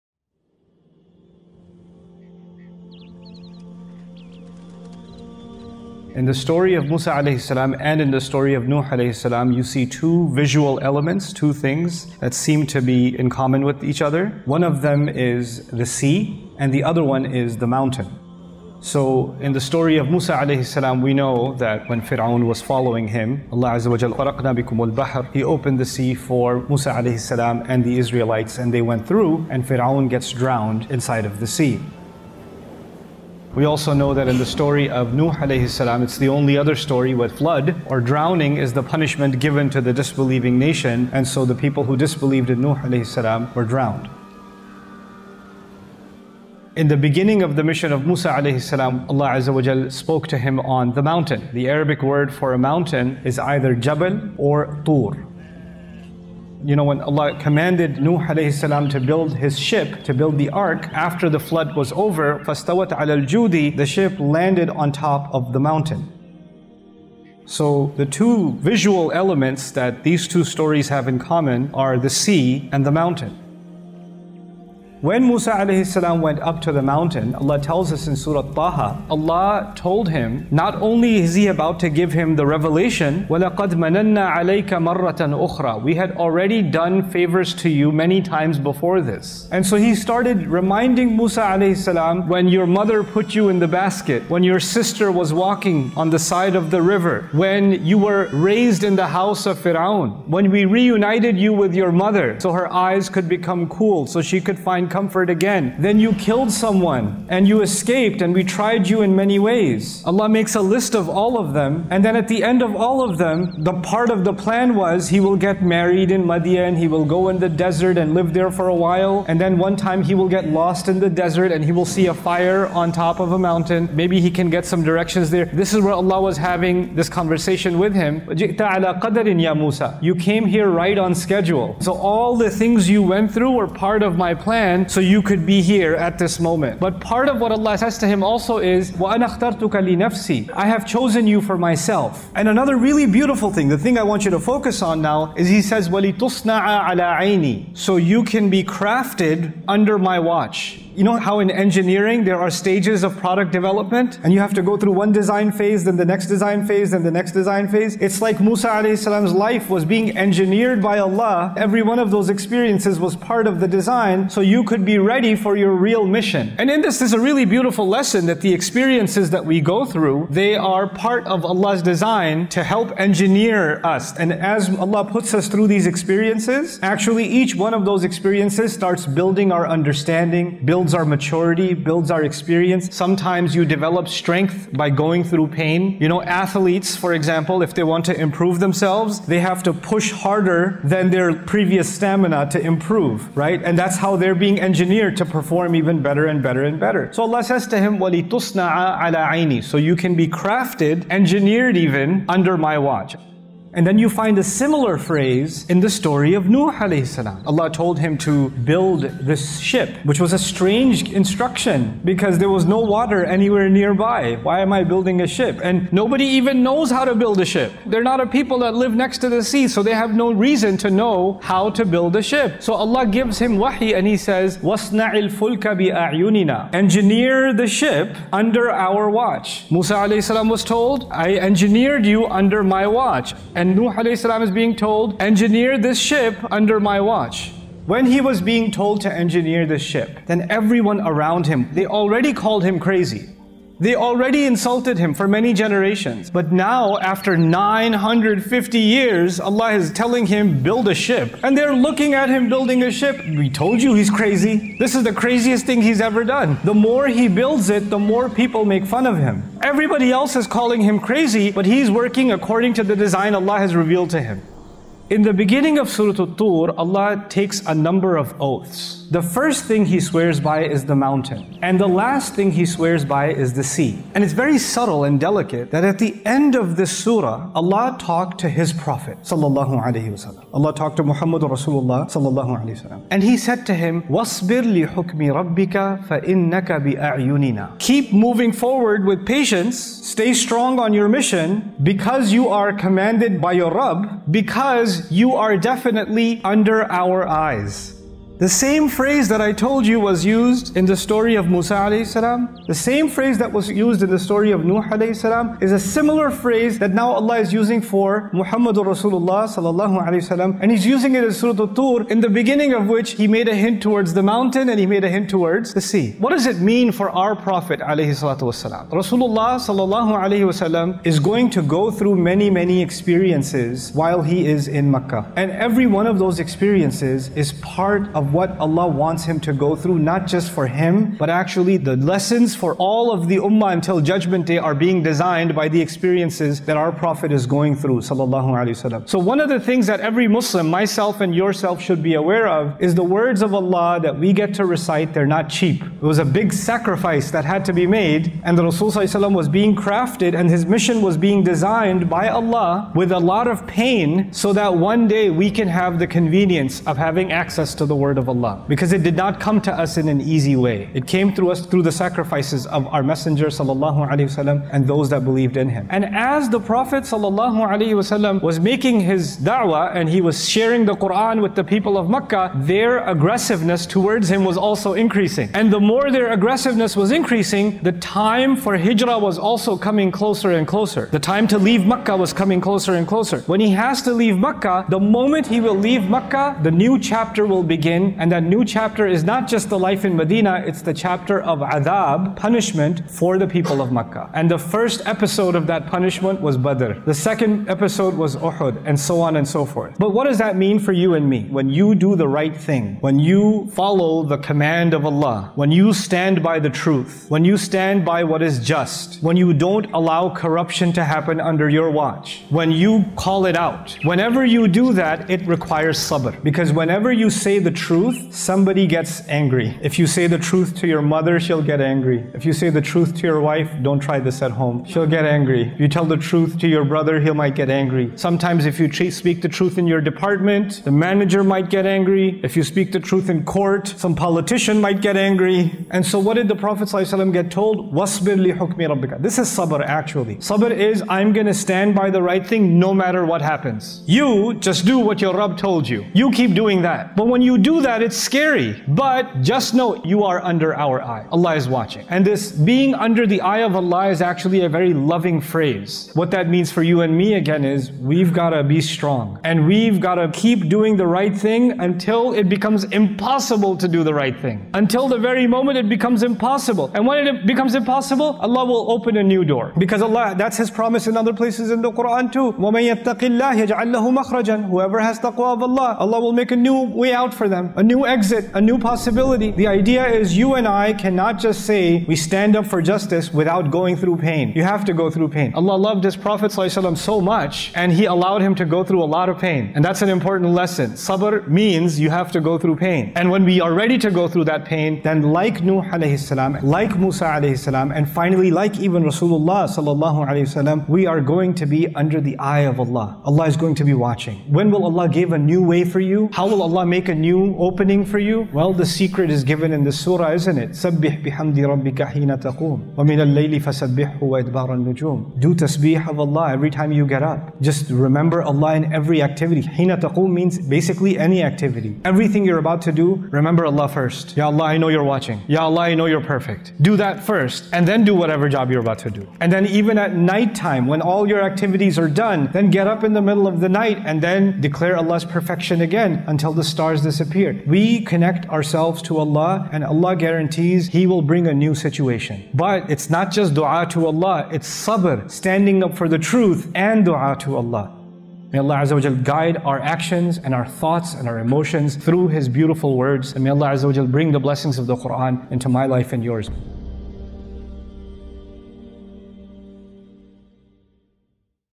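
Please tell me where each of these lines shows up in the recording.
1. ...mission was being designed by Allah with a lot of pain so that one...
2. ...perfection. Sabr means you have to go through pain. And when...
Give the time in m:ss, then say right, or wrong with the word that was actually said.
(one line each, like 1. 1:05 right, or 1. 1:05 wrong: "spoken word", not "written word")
1. 5:50 right
2. 8:10 wrong: "lesson", not "perfection".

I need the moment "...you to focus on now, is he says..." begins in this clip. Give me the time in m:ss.
2:24.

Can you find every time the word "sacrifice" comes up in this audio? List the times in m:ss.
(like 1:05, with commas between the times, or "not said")
5:46, 6:01.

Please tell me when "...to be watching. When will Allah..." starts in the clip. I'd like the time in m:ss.
8:23.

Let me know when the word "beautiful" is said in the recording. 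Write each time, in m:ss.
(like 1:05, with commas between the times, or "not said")
2:23, 2:47, 9:12.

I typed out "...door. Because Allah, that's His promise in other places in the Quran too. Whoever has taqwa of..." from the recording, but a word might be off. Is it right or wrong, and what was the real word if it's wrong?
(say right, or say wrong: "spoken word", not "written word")
right.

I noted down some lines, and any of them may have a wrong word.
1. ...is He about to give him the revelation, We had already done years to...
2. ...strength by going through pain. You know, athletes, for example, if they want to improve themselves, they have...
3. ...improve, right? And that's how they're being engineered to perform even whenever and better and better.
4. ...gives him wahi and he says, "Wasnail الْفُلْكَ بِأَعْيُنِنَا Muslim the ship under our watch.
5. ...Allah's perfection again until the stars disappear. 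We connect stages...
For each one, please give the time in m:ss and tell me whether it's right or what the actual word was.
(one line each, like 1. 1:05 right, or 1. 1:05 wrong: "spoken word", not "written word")
1. 1:21 wrong: "favors", not "years"
2. 3:04 right
3. 3:12 wrong: "better", not "whenever"
4. 3:43 wrong: "Engineer", not "Muslim"
5. 8:54 wrong: "ourselves", not "stages".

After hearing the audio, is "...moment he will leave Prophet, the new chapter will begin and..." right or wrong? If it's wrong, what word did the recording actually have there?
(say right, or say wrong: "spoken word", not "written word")
wrong: "Makkah", not "Prophet".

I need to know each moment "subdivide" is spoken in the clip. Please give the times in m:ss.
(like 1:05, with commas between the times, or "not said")
not said.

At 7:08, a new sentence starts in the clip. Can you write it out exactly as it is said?
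Sometimes if you speak the truth in your department, the manager might get angry.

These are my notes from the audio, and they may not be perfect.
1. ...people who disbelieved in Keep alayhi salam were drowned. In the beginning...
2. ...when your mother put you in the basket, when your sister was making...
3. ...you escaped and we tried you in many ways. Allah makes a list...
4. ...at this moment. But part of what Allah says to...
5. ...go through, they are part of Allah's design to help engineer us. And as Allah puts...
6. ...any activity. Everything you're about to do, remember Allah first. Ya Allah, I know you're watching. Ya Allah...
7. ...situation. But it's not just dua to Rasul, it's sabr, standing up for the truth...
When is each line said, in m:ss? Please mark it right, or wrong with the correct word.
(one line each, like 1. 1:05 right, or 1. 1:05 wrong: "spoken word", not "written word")
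1. 0:41 wrong: "Nuh", not "Keep"
2. 1:32 wrong: "walking", not "making"
3. 1:47 right
4. 2:15 right
5. 2:49 right
6. 8:41 right
7. 9:01 wrong: "Allah", not "Rasul".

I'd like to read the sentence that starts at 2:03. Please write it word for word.
Maybe he can get some directions there.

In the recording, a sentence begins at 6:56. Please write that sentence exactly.
Because whenever you say the truth, truth, somebody gets angry.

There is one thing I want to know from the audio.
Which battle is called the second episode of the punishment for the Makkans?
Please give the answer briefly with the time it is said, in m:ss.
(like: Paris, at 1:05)
Uhud, at 6:38.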